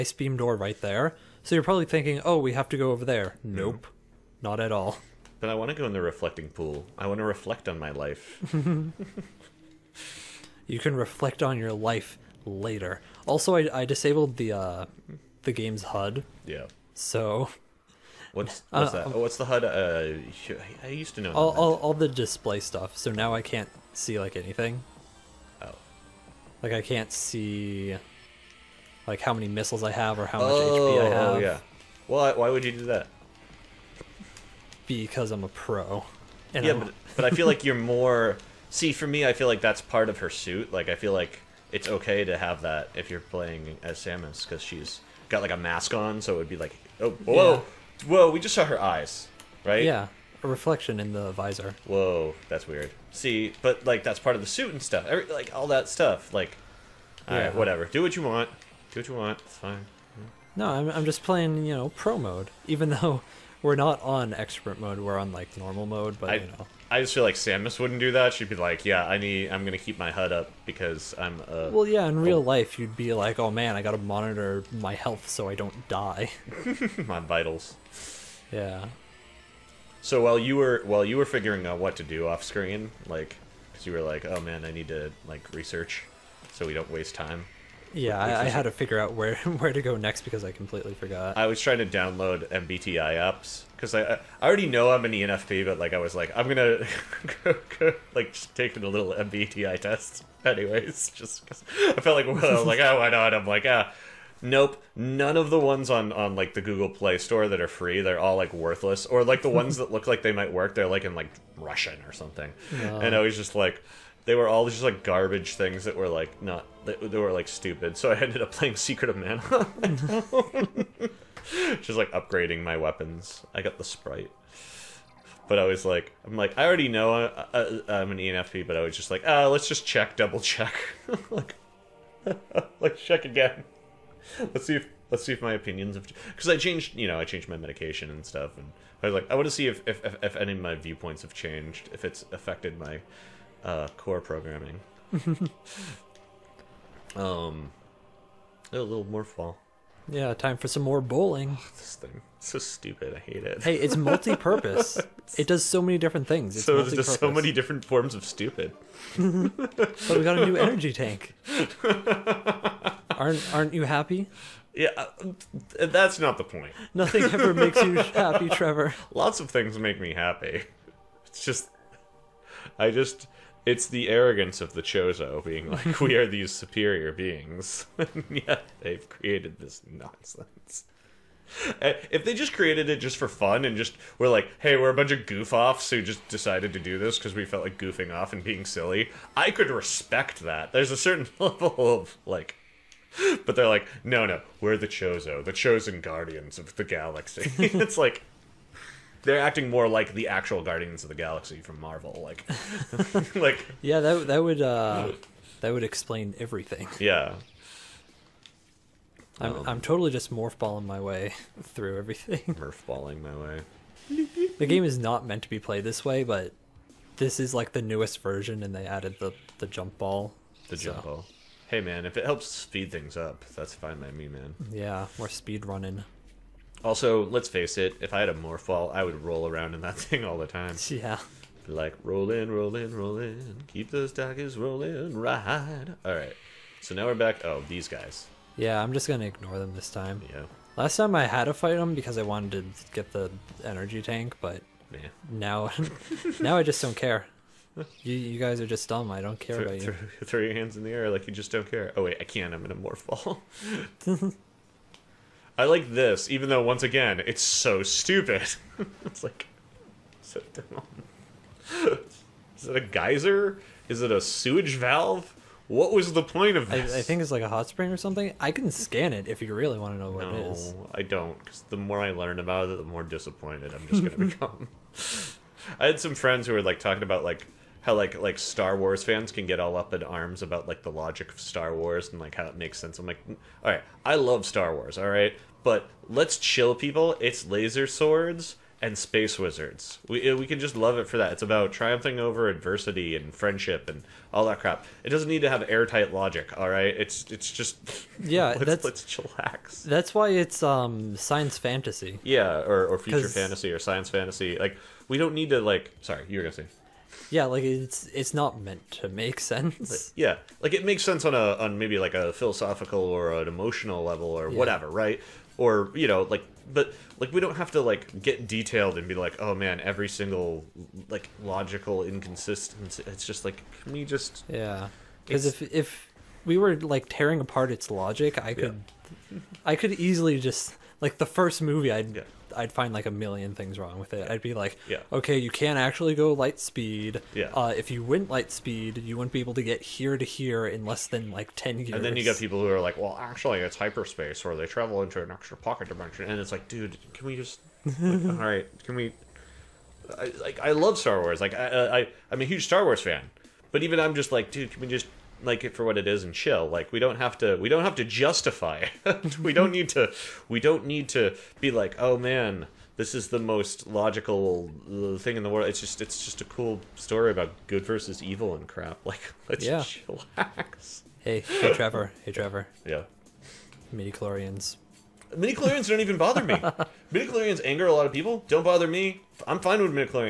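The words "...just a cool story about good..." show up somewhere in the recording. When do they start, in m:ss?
6:06.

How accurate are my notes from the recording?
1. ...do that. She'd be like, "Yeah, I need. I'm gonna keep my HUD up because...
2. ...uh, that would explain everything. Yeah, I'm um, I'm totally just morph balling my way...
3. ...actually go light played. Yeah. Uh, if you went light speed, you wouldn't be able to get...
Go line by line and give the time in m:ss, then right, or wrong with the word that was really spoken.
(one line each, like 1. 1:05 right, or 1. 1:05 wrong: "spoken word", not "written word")
1. 1:07 right
2. 3:24 right
3. 5:35 wrong: "speed", not "played".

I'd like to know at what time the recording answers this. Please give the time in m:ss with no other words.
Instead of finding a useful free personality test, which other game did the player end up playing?
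1:58.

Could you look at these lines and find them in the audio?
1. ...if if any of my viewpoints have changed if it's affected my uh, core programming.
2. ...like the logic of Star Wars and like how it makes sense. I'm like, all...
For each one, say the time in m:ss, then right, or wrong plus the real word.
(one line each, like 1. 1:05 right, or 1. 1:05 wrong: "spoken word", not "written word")
1. 2:19 right
2. 4:40 right.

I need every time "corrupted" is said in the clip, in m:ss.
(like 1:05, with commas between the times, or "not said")
not said.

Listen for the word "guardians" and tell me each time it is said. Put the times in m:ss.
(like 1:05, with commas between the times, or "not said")
3:16, 3:20.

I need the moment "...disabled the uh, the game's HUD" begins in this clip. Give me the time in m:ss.
0:13.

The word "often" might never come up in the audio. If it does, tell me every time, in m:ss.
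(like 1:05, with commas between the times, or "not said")
not said.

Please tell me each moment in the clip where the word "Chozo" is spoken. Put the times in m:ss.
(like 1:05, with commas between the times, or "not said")
2:54, 3:14.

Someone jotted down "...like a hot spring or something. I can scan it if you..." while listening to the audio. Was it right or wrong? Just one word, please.
right.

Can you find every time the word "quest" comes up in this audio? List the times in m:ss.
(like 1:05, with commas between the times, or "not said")
not said.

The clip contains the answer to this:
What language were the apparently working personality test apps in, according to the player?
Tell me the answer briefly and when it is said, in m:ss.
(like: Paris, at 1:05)
Russian, at 1:51.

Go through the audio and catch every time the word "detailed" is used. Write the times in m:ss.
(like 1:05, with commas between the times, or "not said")
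5:18.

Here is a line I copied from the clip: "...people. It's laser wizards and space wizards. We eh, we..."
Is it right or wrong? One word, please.
wrong.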